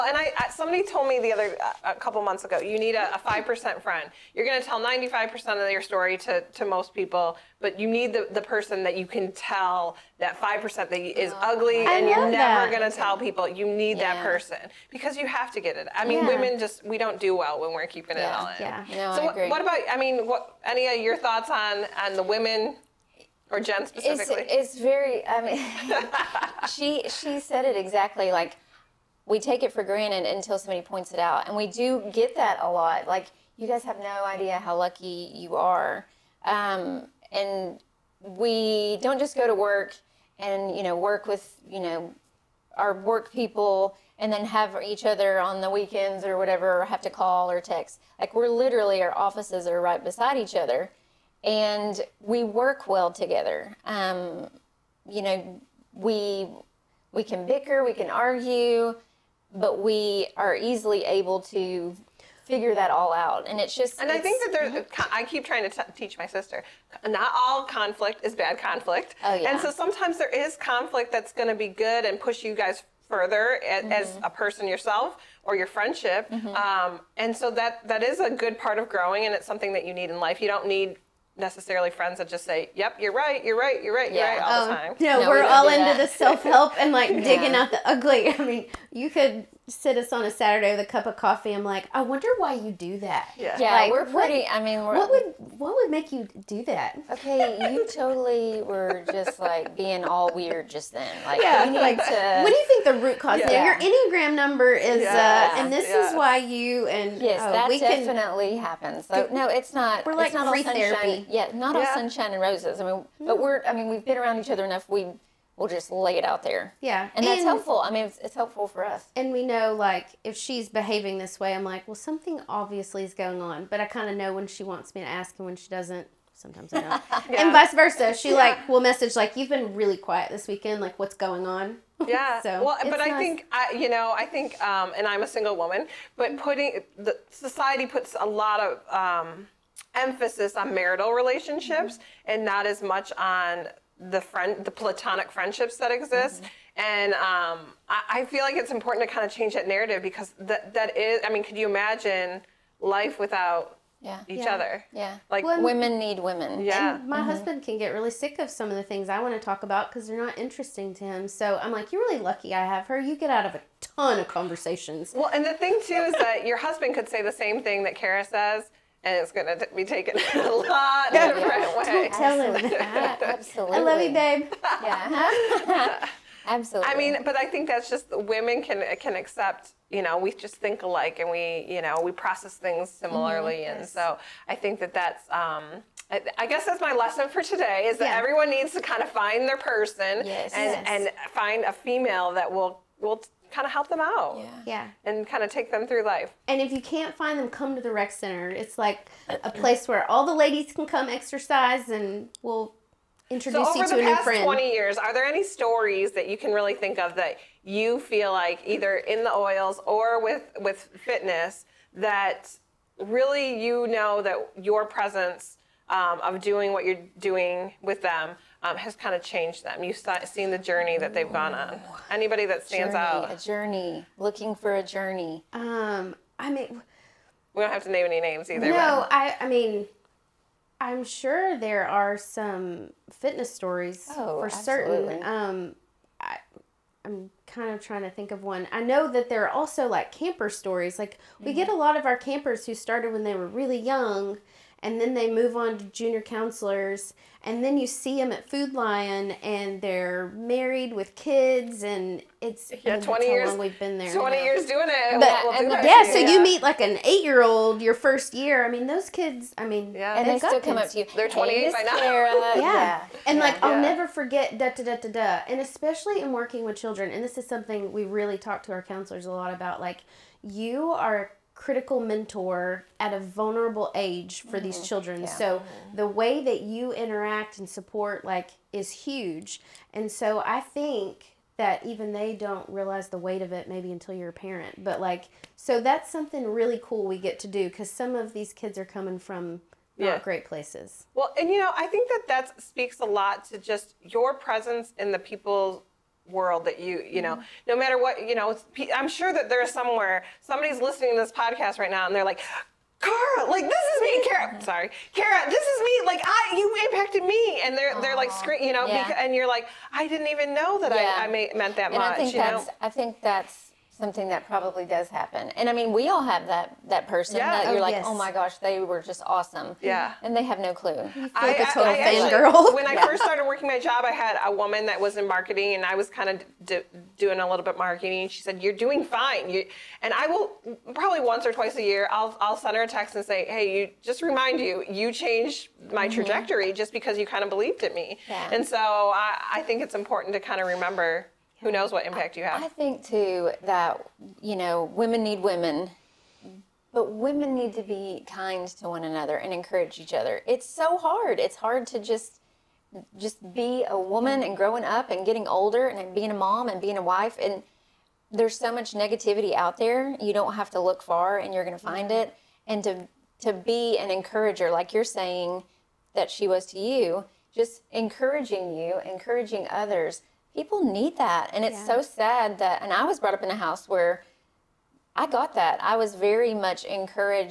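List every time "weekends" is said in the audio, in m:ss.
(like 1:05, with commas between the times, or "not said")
0:45, 2:10.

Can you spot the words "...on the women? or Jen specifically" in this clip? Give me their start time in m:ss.
0:22.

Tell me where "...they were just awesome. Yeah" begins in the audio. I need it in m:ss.
5:18.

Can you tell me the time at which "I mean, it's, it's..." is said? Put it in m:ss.
1:57.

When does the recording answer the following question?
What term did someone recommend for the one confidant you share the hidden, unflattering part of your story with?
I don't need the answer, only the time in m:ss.
0:03.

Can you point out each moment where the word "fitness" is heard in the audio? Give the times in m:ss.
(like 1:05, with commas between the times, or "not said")
3:31, 3:53.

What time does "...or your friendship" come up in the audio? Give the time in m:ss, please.
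1:15.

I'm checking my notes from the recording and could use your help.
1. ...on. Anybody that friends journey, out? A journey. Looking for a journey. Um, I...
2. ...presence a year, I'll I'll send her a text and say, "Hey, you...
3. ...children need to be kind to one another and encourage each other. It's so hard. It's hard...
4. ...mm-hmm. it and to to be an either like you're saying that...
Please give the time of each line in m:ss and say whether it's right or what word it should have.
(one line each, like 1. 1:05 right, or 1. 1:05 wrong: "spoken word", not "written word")
1. 3:41 wrong: "stands", not "friends"
2. 5:31 wrong: "twice", not "presence"
3. 5:47 wrong: "women", not "children"
4. 6:02 wrong: "encourager", not "either".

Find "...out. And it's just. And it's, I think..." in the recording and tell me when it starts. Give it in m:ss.
1:03.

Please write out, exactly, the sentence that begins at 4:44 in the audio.
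But like so that's something really cool we get to do cuz some of these kids are coming from yeah.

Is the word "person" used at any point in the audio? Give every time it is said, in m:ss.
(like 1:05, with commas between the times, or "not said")
0:08, 0:14, 1:14, 3:09, 5:17.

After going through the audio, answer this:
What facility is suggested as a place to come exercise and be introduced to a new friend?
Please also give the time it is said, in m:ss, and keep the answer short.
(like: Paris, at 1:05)
rec center, at 3:17.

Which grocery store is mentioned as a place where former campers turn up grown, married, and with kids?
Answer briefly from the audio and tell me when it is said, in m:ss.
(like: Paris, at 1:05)
Food Lion, at 4:08.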